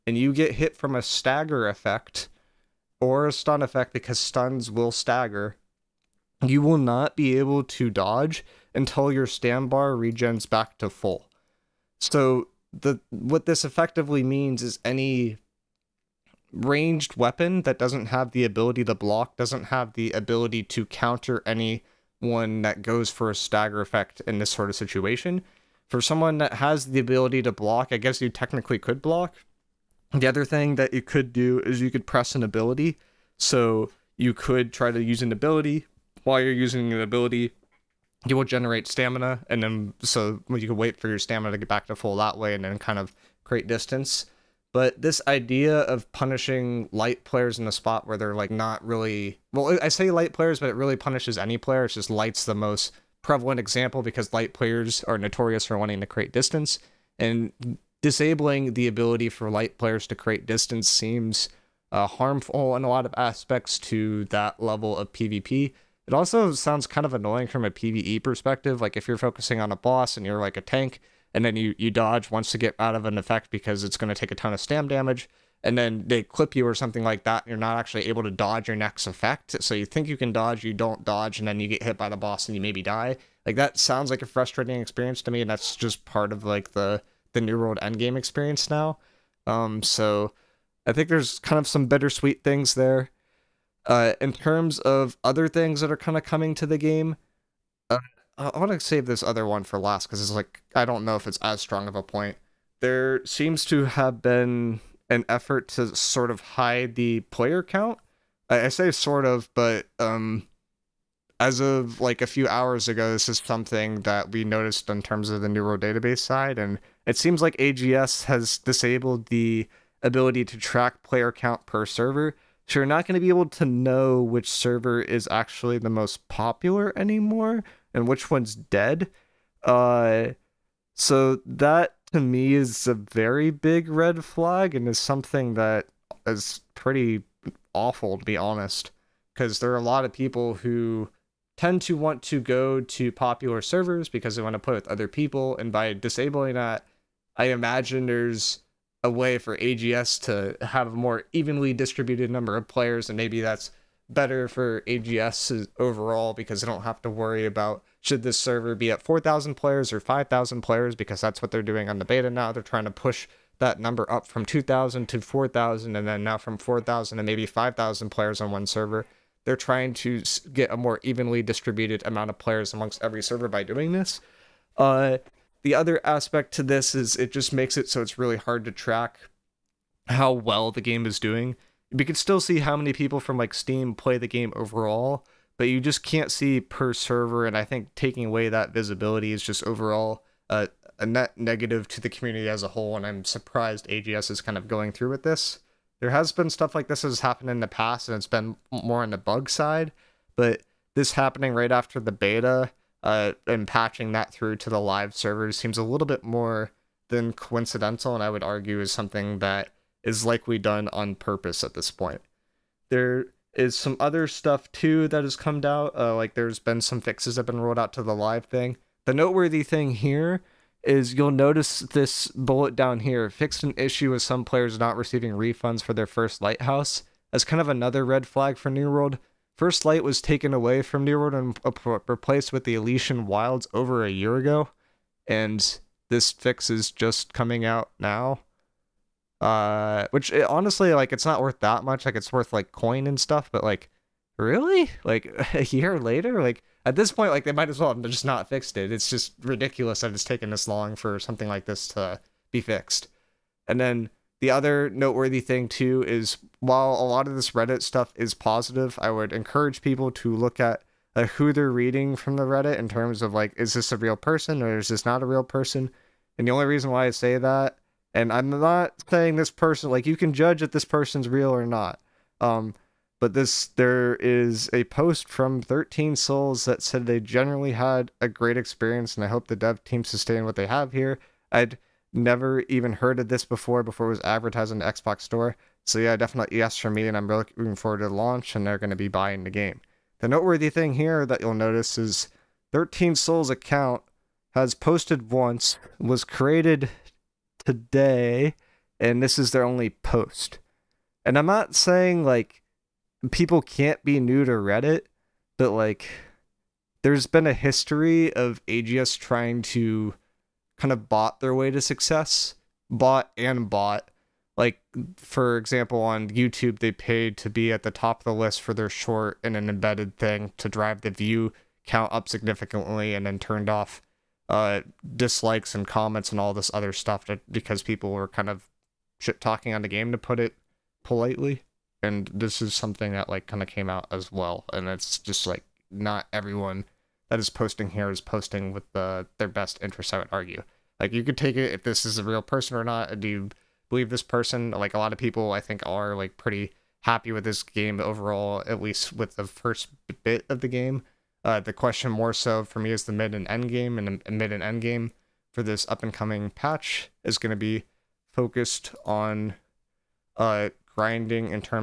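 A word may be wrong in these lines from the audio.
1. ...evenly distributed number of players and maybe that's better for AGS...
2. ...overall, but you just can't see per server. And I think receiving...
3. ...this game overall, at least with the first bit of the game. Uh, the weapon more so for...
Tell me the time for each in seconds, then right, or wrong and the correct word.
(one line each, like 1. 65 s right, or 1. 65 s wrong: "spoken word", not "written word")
1. 151 s right
2. 184 s wrong: "taking", not "receiving"
3. 347 s wrong: "question", not "weapon".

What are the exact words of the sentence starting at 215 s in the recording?
Uh, like there's been some fixes that have been rolled out to the live thing.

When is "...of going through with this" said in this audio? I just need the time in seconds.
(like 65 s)
194 s.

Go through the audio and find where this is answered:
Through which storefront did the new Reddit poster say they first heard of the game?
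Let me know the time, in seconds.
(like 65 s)
284 s.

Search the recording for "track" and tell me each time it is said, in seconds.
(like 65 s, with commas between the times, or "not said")
120 s, 178 s.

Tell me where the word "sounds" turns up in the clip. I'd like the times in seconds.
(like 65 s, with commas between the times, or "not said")
66 s, 83 s.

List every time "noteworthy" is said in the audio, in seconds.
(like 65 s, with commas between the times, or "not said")
219 s, 254 s, 290 s.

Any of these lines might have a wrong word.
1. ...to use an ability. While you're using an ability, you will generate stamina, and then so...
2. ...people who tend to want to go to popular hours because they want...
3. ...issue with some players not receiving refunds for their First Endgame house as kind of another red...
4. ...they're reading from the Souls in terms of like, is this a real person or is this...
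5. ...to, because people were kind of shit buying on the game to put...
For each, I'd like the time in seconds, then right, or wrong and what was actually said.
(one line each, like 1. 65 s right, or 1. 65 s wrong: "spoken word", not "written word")
1. 34 s right
2. 140 s wrong: "servers", not "hours"
3. 223 s wrong: "Light", not "Endgame"
4. 261 s wrong: "Reddit", not "Souls"
5. 327 s wrong: "talking", not "buying".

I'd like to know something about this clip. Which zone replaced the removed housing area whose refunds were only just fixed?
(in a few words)
Elysian Wilds.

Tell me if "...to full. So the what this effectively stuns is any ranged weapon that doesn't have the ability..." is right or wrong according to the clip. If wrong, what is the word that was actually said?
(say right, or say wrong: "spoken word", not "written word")
wrong: "means", not "stuns".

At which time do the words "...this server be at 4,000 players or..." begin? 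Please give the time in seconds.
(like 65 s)
158 s.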